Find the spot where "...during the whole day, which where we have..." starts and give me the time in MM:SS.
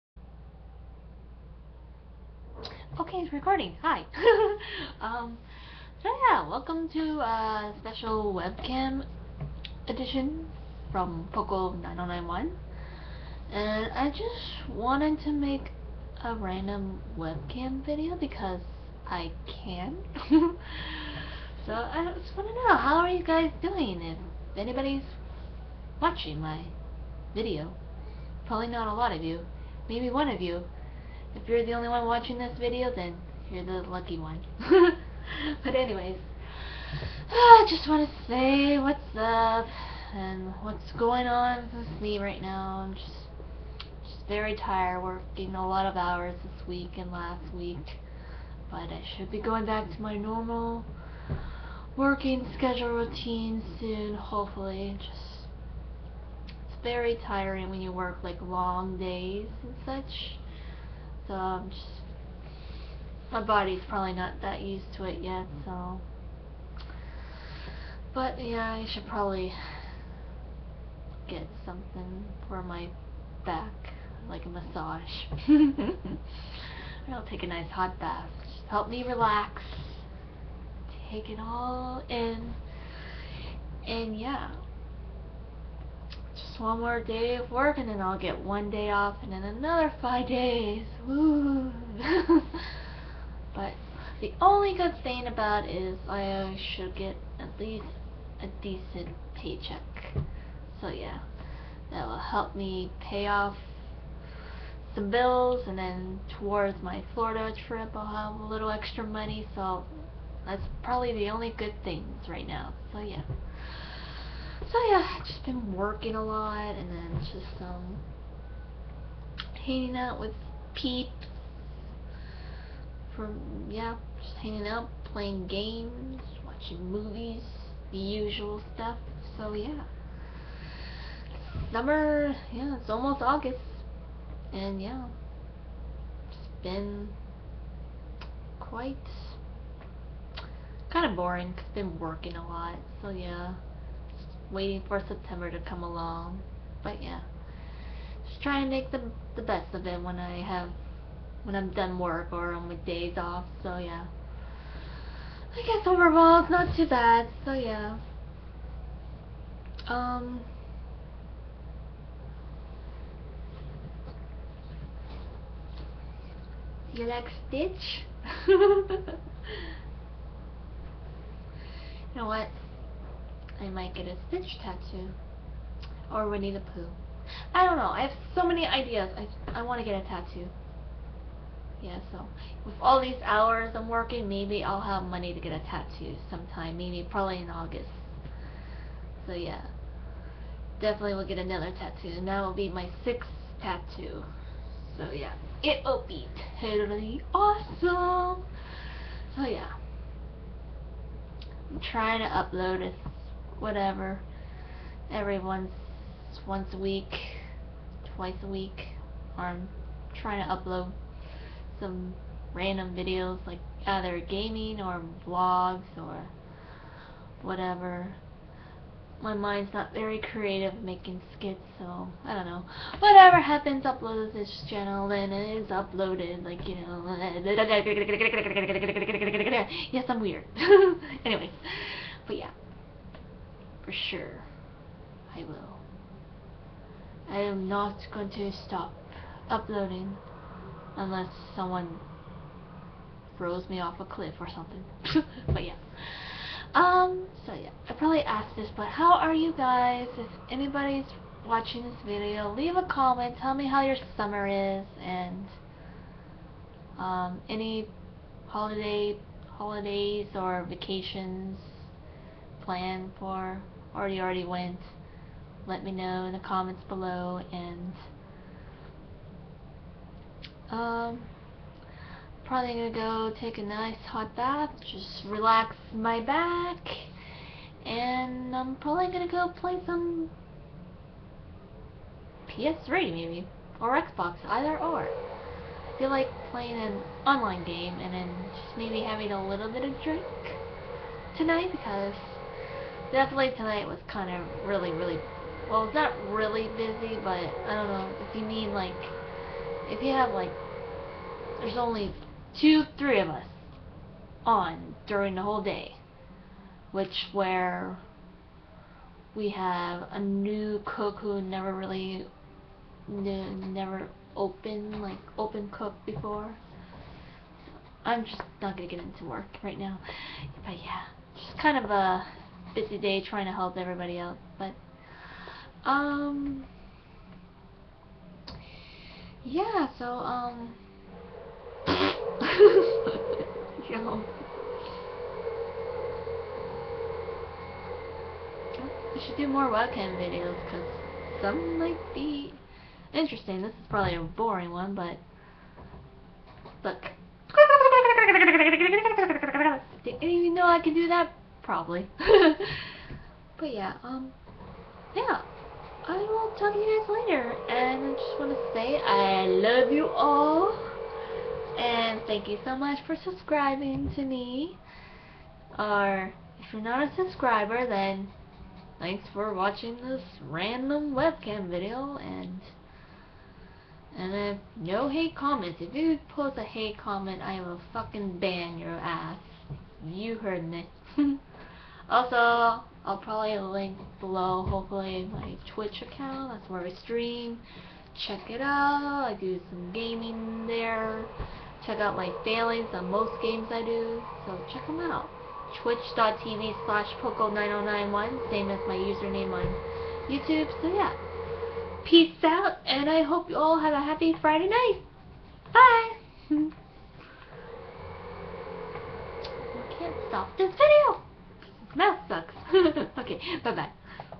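05:05.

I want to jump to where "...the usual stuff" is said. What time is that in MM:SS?
02:07.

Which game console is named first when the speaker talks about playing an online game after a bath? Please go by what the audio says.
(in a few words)
PS3.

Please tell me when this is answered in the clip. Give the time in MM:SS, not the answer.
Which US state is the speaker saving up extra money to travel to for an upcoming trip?
01:47.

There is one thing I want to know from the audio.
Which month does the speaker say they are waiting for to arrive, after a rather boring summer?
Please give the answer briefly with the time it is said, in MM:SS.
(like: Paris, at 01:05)
September, at 02:25.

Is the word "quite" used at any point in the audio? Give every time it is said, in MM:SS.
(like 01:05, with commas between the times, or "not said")
02:18.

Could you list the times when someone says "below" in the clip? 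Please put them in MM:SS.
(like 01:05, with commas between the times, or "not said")
04:26, 06:24.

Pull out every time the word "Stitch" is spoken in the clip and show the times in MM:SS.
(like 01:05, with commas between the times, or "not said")
02:47, 02:54.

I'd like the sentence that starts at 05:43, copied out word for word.
This is probably a boring one, but look.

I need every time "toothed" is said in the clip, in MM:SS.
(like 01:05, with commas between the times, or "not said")
not said.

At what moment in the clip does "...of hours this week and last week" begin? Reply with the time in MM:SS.
00:45.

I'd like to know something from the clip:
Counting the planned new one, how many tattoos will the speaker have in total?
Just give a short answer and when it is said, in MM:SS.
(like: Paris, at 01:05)
6, at 03:13.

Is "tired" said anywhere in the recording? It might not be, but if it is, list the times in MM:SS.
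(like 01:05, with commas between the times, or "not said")
00:44.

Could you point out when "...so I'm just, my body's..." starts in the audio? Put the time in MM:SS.
01:01.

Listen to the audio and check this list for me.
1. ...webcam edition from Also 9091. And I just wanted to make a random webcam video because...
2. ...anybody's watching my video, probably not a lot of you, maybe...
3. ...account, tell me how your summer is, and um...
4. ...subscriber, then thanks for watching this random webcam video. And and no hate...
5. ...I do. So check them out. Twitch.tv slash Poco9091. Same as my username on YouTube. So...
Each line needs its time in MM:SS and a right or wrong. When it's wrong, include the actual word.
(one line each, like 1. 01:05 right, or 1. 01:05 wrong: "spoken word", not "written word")
1. 00:08 wrong: "Poco", not "Also"
2. 00:24 right
3. 04:12 wrong: "comment", not "account"
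4. 06:07 right
5. 06:33 right.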